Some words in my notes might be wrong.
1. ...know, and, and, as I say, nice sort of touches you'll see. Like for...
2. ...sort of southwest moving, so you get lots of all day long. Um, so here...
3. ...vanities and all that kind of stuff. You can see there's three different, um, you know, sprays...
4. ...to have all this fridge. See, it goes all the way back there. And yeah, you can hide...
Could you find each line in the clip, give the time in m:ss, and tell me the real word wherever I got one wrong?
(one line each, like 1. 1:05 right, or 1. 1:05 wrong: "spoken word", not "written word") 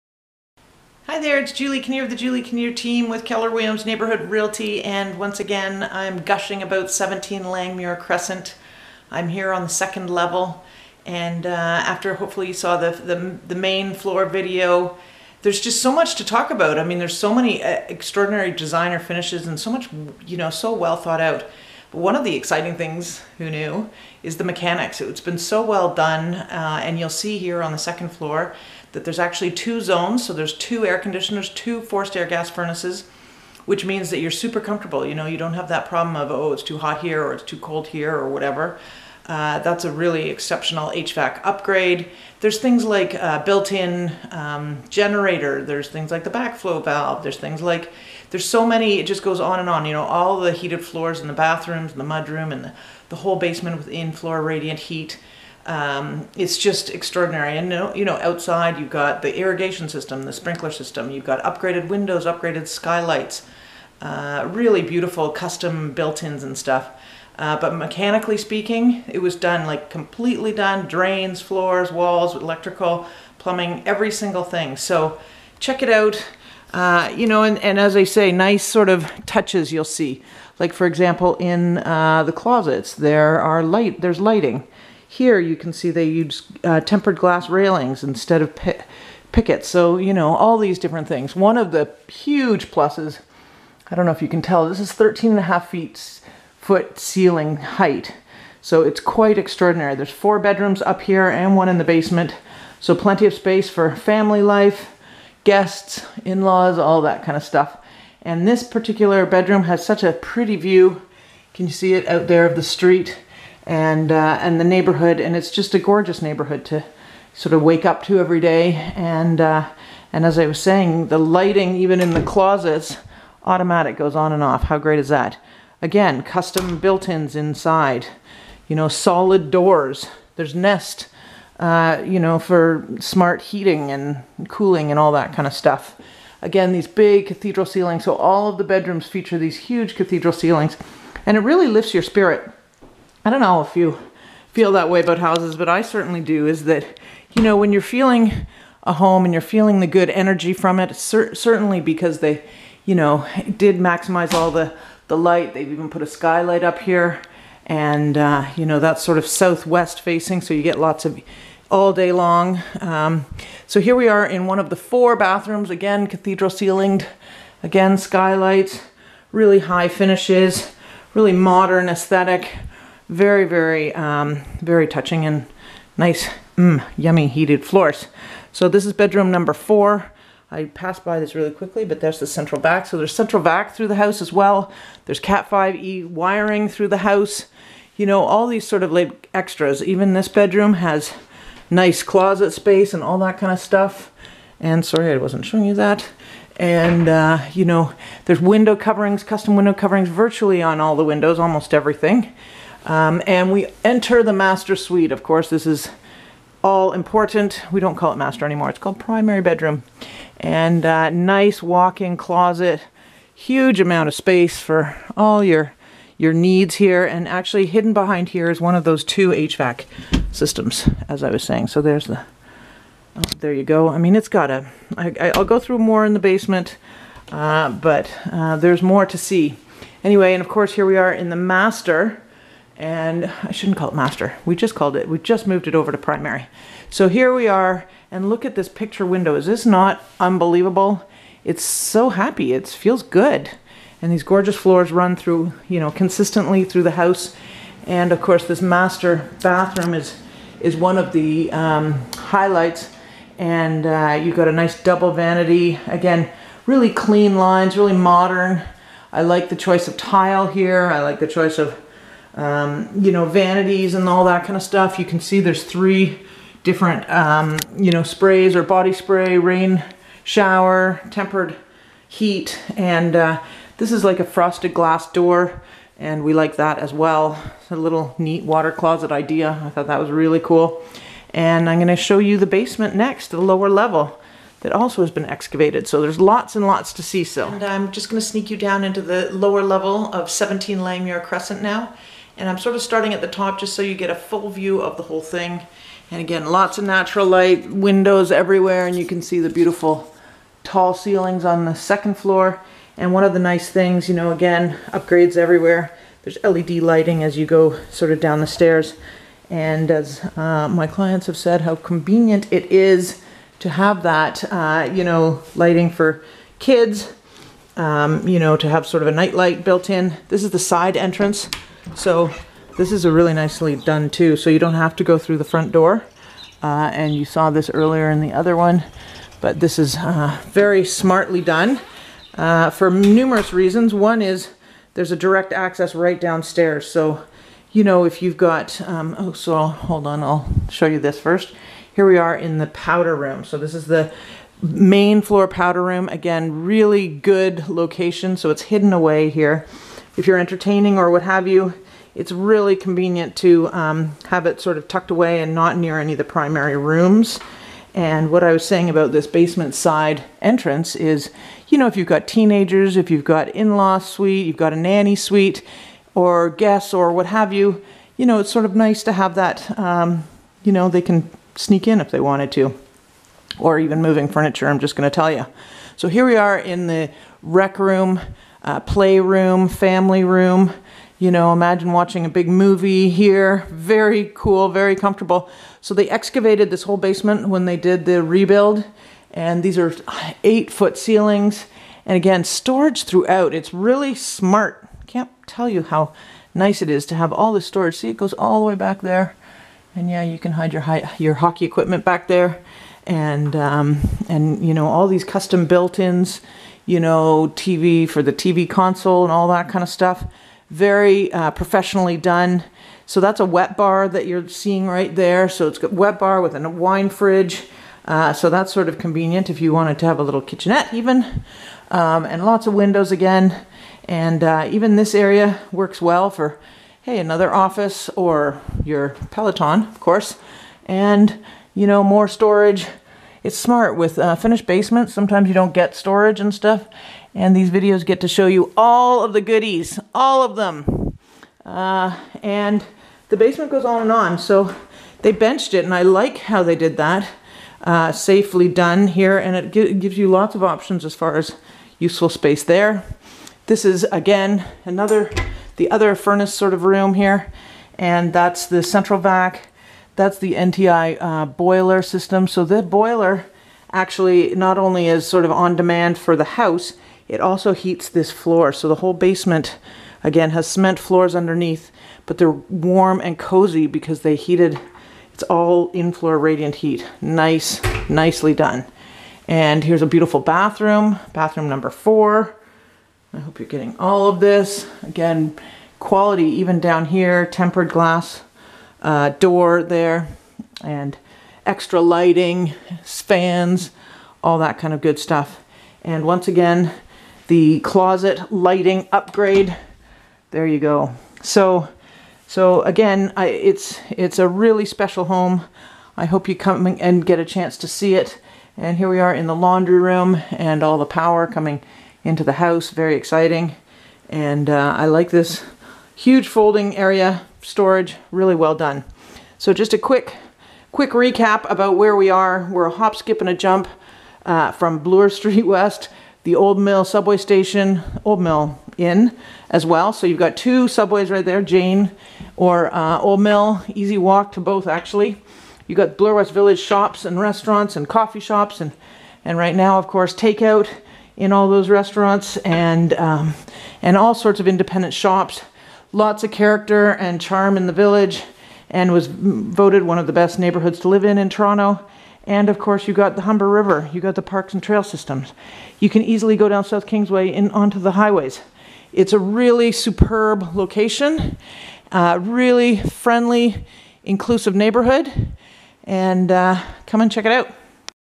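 1. 1:17 right
2. 2:39 wrong: "facing", not "moving"
3. 4:23 right
4. 6:37 wrong: "storage", not "fridge".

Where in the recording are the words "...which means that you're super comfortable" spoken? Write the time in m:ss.
0:33.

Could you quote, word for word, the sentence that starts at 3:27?
We don't call it master anymore.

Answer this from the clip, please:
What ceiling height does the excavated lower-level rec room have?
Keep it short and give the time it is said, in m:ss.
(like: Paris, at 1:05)
8 feet, at 6:30.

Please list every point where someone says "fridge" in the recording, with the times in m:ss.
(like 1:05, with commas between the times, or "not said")
6:57.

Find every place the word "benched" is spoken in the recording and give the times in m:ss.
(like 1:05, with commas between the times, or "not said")
7:25.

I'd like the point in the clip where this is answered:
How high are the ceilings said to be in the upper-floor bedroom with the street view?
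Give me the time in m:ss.
1:34.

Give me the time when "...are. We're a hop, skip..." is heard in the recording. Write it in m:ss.
8:42.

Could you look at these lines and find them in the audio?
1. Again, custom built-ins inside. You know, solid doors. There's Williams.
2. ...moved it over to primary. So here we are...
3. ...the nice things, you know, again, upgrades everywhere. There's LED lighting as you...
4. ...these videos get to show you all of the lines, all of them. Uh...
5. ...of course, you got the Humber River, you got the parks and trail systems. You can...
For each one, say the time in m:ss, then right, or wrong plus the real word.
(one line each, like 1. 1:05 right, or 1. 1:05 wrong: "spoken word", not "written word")
1. 2:05 wrong: "Nest", not "Williams"
2. 3:55 right
3. 5:03 right
4. 7:17 wrong: "goodies", not "lines"
5. 9:12 right.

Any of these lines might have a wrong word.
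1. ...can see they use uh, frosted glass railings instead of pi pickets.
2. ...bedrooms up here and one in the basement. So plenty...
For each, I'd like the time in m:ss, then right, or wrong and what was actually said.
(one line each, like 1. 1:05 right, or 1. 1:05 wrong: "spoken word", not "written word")
1. 1:25 wrong: "tempered", not "frosted"
2. 1:40 right.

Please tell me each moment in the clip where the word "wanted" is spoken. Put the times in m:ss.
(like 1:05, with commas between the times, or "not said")
6:12, 6:59.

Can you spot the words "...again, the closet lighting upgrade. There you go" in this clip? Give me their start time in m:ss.
8:16.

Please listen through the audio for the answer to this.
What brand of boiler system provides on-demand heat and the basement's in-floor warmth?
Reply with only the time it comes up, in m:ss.
7:40.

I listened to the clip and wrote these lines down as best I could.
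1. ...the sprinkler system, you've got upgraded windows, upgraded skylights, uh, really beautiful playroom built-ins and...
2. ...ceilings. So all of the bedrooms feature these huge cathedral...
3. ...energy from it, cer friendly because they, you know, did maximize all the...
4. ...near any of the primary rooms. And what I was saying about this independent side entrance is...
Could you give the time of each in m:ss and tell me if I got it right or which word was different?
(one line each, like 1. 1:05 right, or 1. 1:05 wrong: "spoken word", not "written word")
1. 1:00 wrong: "custom", not "playroom"
2. 2:17 right
3. 2:30 wrong: "certainly", not "friendly"
4. 5:55 wrong: "basement", not "independent".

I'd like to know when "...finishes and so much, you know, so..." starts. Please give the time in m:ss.
0:18.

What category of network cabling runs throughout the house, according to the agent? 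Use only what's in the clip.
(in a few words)
Cat 5e.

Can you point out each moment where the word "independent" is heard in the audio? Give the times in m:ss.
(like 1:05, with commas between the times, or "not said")
9:04.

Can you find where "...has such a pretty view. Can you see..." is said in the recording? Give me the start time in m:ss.
1:49.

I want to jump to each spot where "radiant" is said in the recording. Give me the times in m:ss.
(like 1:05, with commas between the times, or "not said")
0:54, 7:56.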